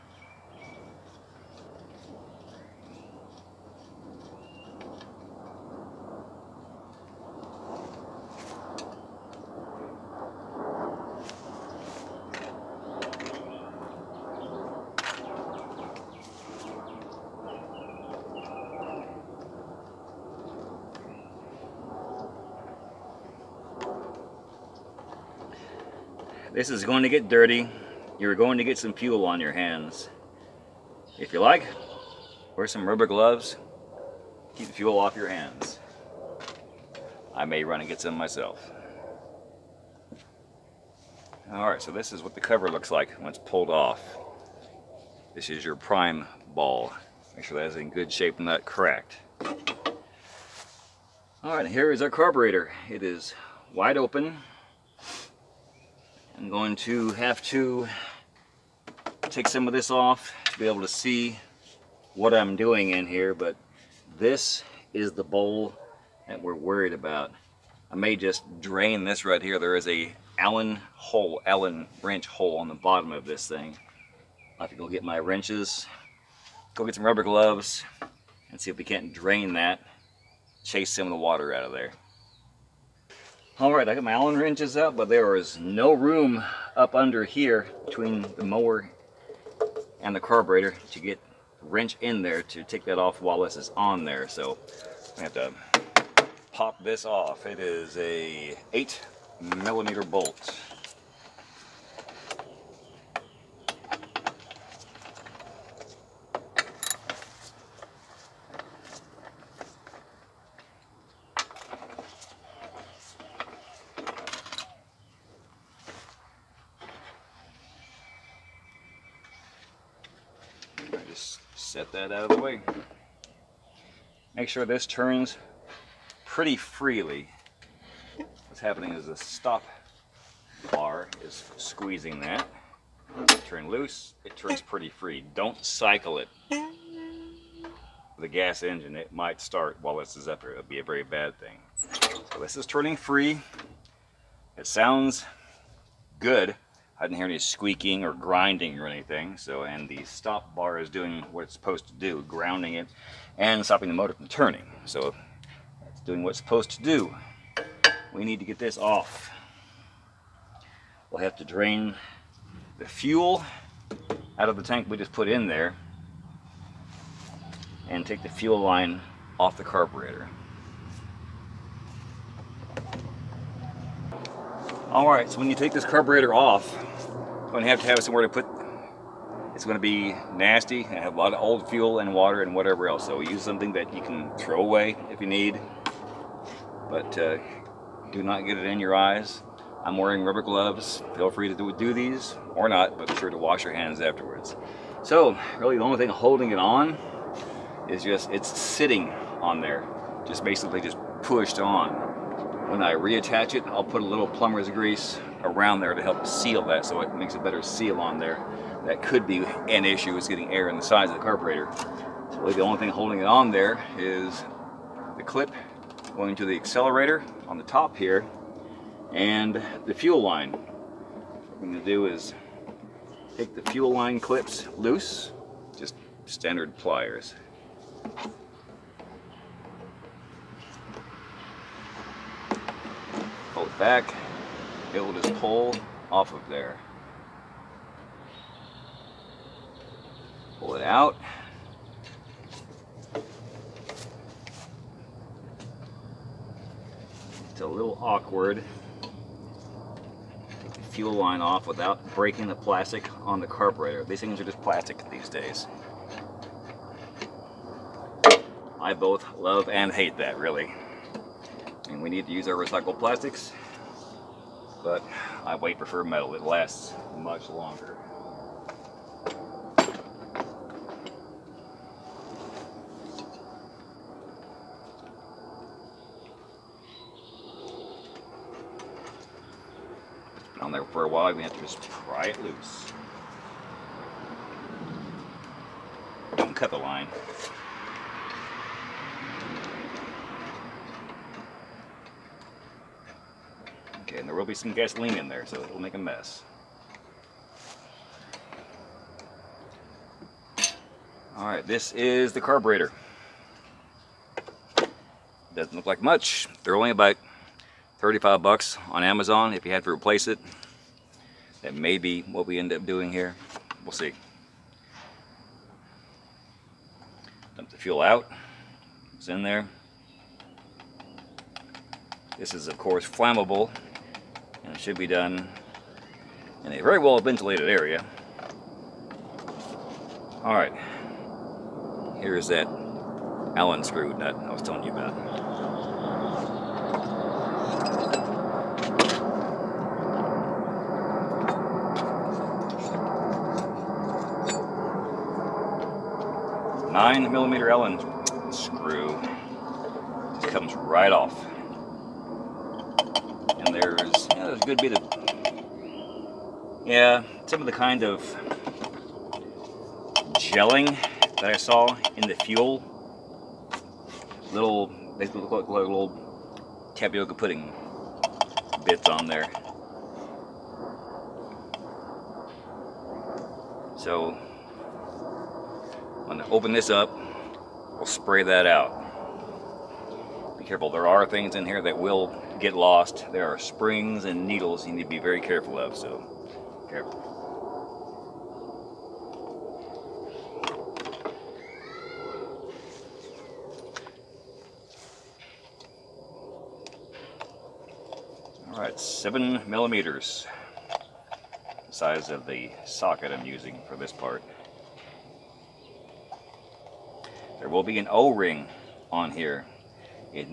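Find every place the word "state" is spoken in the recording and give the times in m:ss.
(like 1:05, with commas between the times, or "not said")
not said.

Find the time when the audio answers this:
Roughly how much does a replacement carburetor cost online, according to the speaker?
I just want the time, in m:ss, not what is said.
5:07.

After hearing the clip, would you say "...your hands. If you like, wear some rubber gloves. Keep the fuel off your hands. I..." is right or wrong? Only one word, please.
right.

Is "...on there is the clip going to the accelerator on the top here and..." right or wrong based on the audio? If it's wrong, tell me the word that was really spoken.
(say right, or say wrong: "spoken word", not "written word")
right.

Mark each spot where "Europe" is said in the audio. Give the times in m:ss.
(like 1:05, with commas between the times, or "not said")
not said.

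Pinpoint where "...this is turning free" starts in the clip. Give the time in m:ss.
2:22.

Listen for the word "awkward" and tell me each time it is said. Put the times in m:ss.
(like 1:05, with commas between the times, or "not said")
4:08.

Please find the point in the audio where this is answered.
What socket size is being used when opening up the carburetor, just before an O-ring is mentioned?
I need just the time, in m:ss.
6:38.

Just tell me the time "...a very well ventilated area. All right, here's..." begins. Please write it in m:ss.
5:26.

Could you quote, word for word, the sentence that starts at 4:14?
These things are just plastic these days.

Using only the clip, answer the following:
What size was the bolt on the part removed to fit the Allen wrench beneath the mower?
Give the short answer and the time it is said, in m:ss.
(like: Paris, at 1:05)
8 millimeter, at 1:38.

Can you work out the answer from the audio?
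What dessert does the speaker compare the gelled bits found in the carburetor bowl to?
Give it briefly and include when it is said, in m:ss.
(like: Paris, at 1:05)
tapioca pudding, at 6:06.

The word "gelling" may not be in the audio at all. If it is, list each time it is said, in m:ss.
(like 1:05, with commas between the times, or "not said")
6:00.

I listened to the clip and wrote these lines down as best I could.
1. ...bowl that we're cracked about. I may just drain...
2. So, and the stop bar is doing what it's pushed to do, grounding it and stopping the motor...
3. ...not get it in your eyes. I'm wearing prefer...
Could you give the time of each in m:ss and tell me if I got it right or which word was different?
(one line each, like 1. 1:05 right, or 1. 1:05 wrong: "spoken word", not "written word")
1. 1:05 wrong: "worried", not "cracked"
2. 2:29 wrong: "supposed", not "pushed"
3. 3:08 wrong: "rubber", not "prefer".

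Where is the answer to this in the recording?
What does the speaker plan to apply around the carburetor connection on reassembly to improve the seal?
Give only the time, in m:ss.
3:24.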